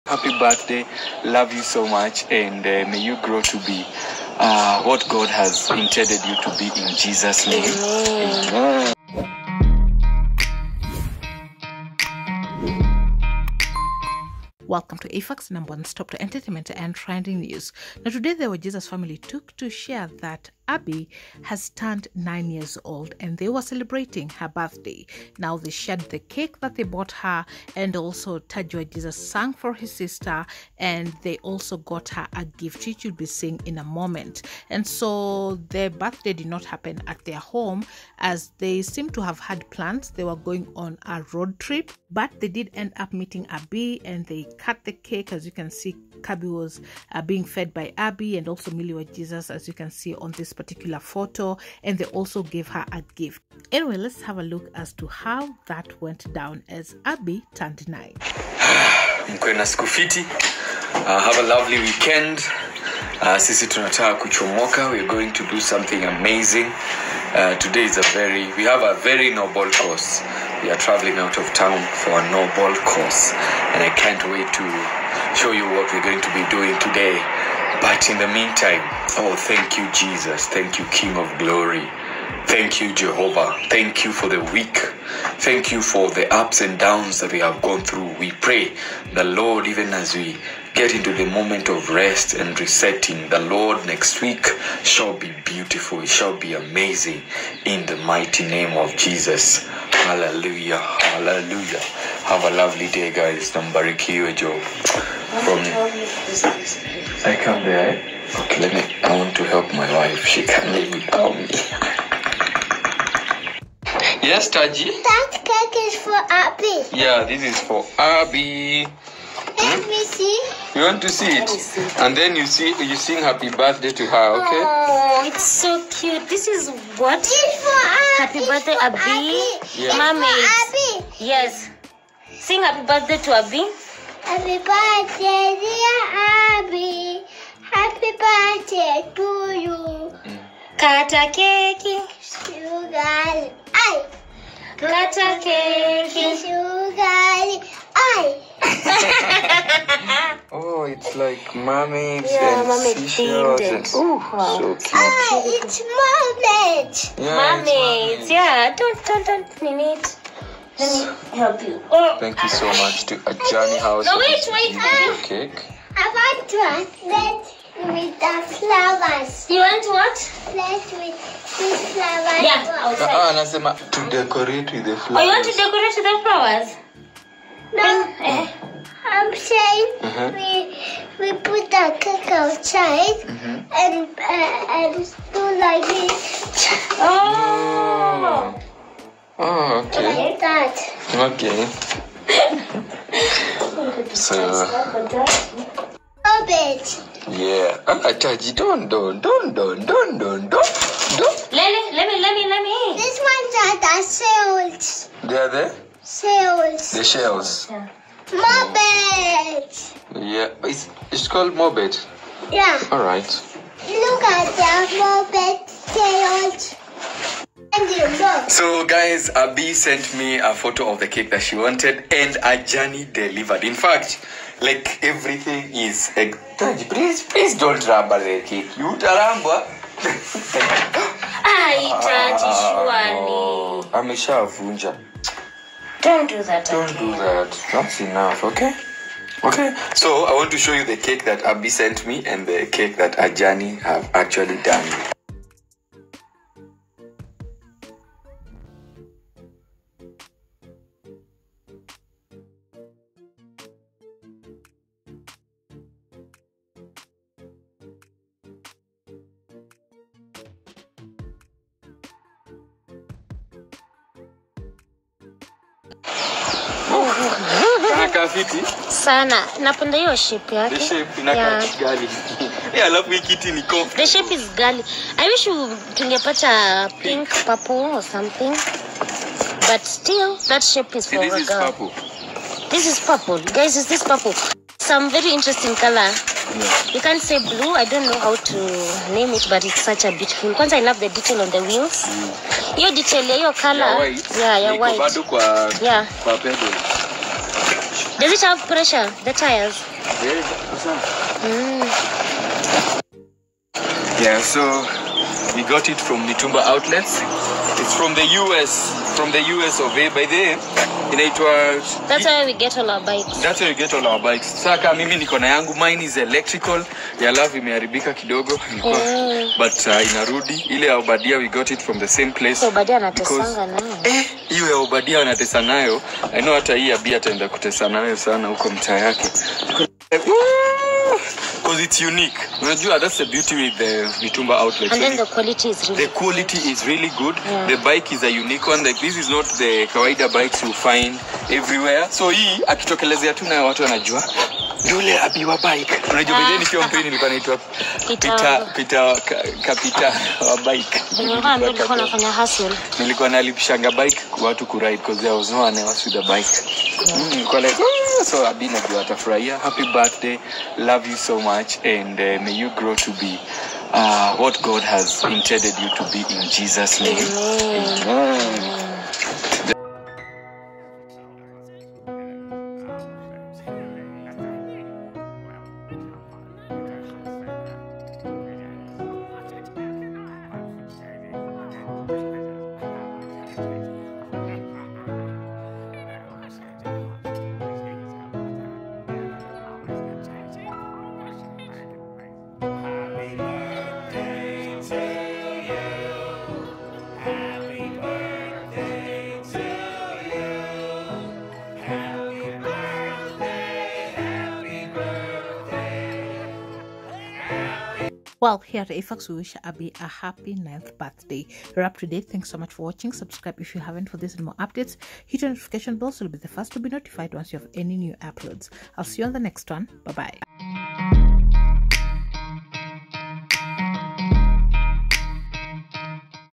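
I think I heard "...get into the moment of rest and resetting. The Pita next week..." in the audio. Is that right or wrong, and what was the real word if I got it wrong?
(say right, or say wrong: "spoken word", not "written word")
wrong: "Lord", not "Pita".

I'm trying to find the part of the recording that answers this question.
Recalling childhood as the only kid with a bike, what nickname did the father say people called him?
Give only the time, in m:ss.
5:48.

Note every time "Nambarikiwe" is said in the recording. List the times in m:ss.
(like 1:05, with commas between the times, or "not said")
1:43.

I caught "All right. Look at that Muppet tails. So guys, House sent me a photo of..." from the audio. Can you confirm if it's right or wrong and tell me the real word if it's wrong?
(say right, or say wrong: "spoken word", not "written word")
wrong: "Abby", not "House".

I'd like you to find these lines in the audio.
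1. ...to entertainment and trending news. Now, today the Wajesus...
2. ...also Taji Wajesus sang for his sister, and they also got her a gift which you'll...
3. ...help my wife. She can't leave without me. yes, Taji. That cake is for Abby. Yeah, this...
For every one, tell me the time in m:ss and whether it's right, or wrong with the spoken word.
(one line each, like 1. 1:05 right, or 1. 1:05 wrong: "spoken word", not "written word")
1. 0:16 right
2. 0:27 right
3. 1:49 right.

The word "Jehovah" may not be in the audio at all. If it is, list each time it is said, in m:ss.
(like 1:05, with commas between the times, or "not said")
1:22.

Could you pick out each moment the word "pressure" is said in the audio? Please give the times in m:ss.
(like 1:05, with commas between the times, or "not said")
4:58.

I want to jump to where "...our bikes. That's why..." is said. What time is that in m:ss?
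5:12.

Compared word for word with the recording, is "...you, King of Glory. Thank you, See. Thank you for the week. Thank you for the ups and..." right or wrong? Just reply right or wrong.
wrong.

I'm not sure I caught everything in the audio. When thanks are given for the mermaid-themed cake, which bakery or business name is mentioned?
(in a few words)
Ajani House.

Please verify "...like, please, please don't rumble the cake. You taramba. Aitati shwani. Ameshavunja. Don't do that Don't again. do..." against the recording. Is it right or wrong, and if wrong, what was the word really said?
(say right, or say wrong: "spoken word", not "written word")
right.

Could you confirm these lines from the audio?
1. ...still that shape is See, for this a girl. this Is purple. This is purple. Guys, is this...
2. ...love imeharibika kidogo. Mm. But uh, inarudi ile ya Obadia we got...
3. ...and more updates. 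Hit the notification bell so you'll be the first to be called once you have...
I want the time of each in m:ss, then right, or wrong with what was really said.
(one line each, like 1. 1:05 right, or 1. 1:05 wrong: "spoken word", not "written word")
1. 4:39 right
2. 5:17 right
3. 6:54 wrong: "notified", not "called".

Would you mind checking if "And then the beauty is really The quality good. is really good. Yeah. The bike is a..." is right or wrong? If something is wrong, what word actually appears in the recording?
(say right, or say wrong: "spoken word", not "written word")
wrong: "quality", not "beauty".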